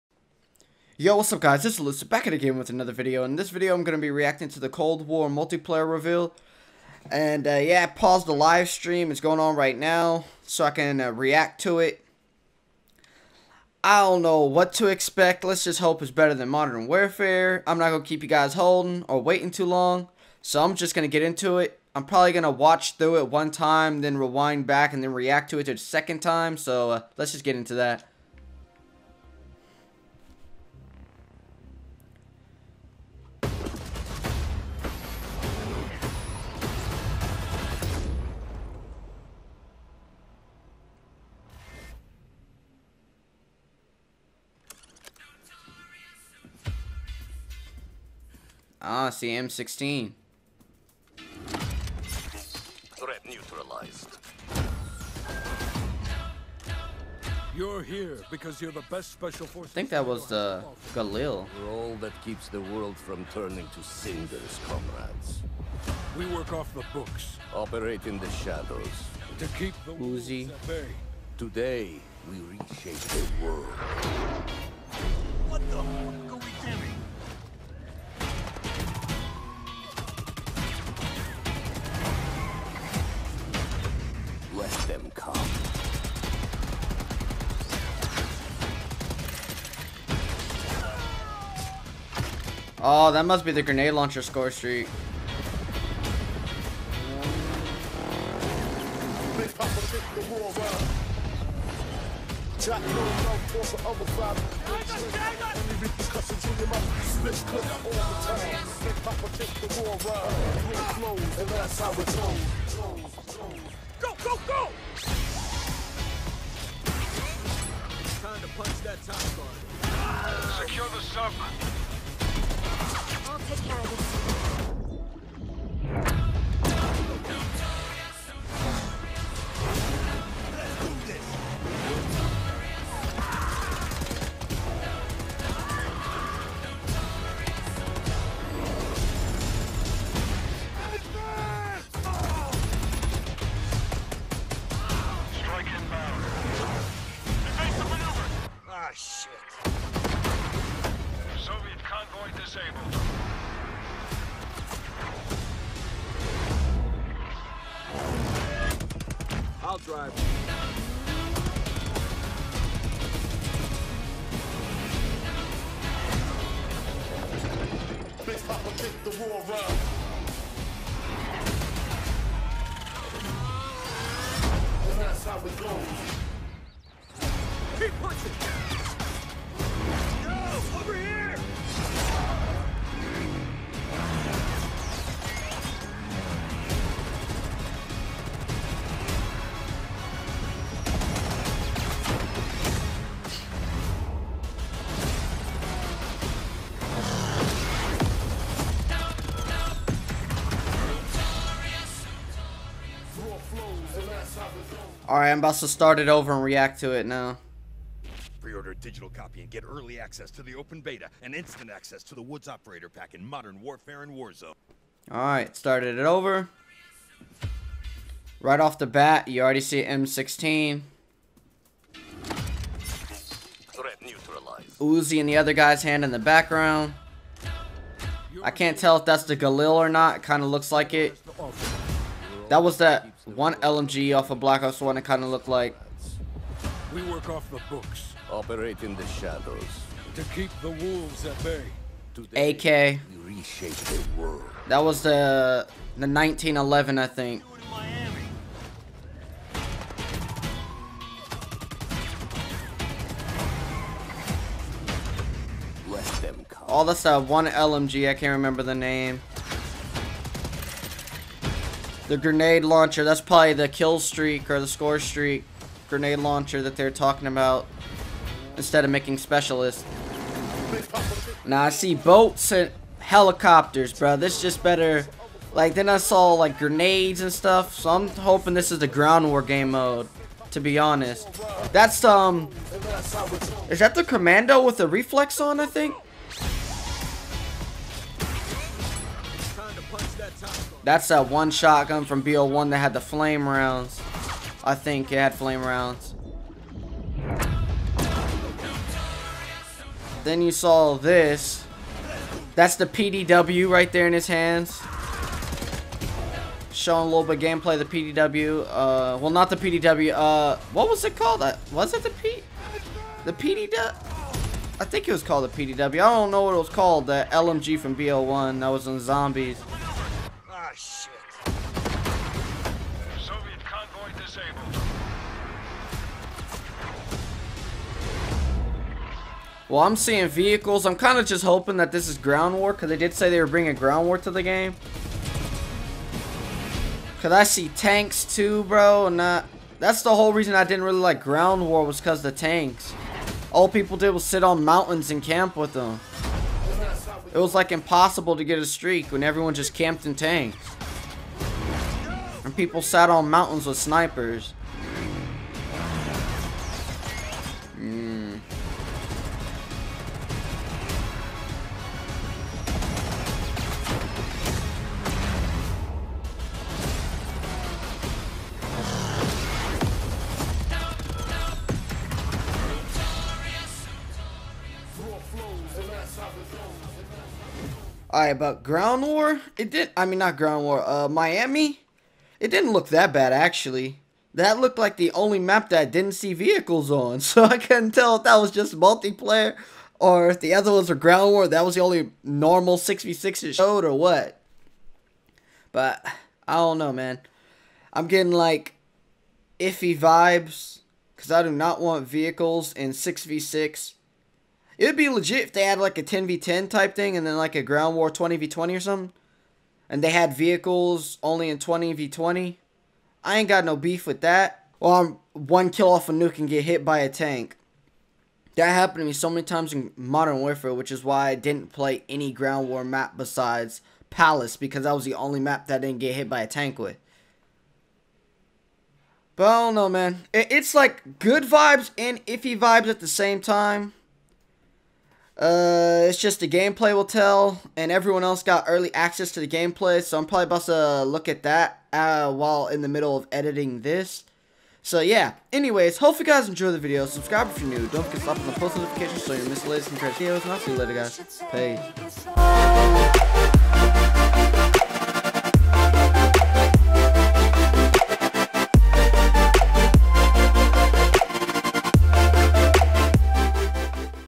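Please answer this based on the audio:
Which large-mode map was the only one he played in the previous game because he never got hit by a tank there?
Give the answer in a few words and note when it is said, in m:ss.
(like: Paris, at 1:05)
Palace, at 7:04.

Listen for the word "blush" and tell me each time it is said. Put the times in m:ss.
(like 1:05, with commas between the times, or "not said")
not said.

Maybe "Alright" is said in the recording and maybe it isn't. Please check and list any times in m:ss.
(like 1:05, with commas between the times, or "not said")
3:25, 3:35, 6:18.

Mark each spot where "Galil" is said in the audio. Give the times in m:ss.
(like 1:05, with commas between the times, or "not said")
1:00, 3:49.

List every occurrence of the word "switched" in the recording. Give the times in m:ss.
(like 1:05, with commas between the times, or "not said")
not said.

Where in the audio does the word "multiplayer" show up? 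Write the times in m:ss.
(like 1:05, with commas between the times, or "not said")
0:05, 6:28.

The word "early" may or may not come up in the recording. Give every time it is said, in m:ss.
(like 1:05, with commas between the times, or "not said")
3:29, 7:18.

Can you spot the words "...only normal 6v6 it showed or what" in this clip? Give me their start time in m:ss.
6:31.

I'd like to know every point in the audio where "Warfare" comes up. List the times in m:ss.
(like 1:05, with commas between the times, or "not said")
0:16, 3:33, 7:00.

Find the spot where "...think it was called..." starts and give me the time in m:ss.
5:14.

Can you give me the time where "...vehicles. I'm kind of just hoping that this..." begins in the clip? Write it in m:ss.
5:30.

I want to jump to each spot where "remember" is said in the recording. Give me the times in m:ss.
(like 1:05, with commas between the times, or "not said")
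4:18.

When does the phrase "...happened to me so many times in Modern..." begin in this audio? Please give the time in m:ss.
6:58.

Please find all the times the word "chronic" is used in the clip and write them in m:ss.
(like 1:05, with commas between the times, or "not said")
not said.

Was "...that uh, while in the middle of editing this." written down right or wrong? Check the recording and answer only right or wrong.
right.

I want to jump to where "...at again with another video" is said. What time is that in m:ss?
0:02.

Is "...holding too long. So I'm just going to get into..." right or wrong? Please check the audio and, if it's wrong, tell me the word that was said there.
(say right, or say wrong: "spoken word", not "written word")
wrong: "waiting", not "holding".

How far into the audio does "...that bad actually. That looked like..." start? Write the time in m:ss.
6:22.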